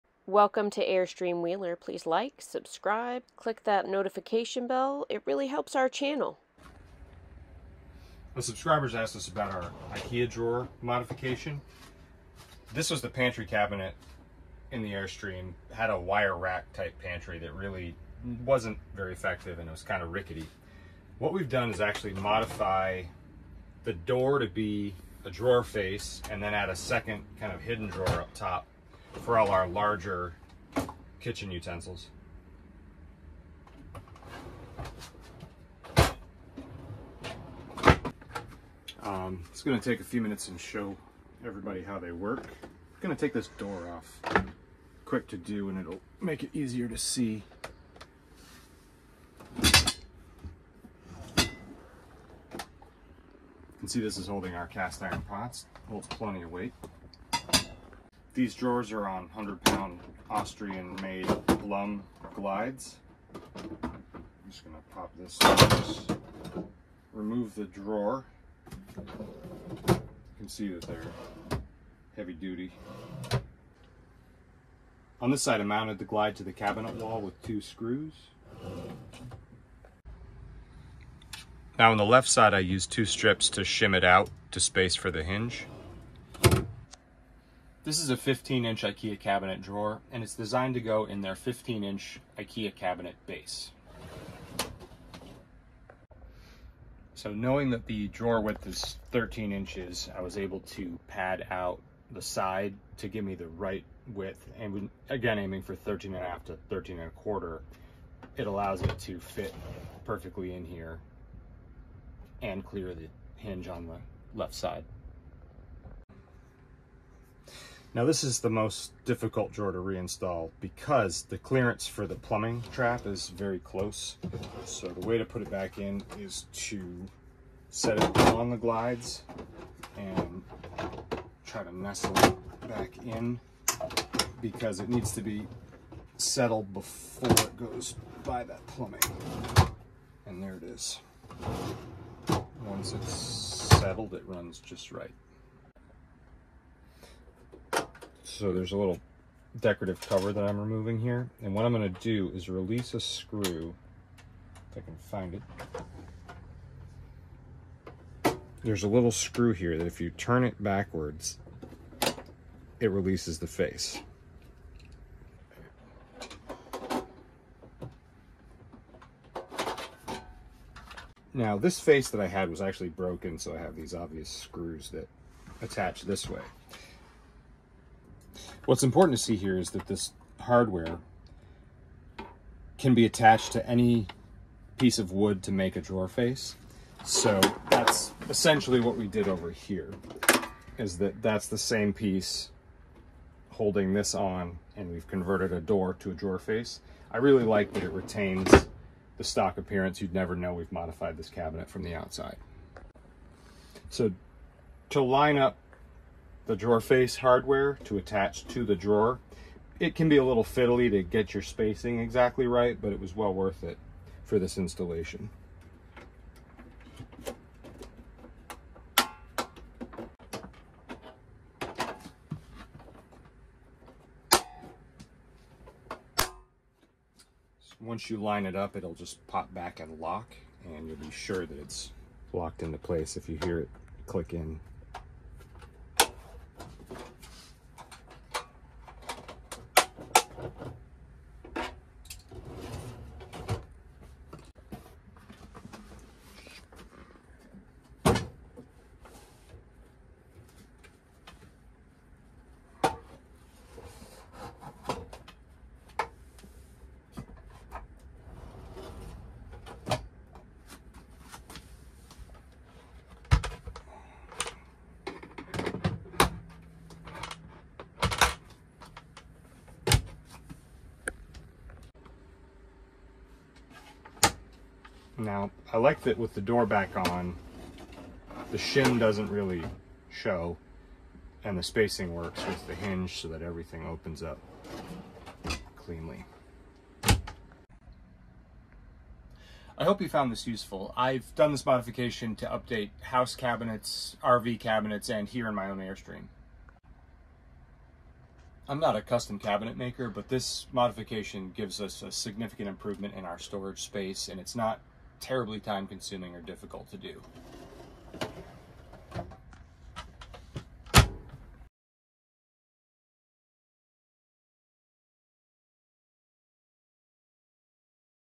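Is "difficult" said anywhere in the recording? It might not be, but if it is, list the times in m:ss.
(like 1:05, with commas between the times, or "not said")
1:59, 5:06.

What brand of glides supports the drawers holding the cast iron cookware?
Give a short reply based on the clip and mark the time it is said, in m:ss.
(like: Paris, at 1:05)
Blum, at 1:01.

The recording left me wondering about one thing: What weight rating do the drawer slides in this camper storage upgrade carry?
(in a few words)
100 pounds.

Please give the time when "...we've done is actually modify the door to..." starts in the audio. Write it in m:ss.
0:21.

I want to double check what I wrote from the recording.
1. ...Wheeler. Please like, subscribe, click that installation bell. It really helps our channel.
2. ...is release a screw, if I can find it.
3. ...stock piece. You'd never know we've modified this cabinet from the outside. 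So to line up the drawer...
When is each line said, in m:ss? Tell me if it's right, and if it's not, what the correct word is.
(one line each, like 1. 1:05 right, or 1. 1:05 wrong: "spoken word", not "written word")
1. 0:01 wrong: "notification", not "installation"
2. 2:32 right
3. 3:19 wrong: "appearance", not "piece".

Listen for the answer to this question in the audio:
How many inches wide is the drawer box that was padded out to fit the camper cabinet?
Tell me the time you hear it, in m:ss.
1:39.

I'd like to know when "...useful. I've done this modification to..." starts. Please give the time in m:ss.
4:50.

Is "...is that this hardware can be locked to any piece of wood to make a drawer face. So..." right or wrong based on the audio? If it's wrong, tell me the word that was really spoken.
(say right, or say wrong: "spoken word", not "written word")
wrong: "attached", not "locked".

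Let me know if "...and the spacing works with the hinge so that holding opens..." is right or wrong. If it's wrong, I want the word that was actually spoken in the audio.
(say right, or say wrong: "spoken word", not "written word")
wrong: "everything", not "holding".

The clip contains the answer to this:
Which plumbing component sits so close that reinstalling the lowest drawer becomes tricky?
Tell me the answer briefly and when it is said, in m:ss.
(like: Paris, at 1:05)
plumbing trap, at 2:02.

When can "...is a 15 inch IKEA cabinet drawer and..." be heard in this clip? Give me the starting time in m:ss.
1:27.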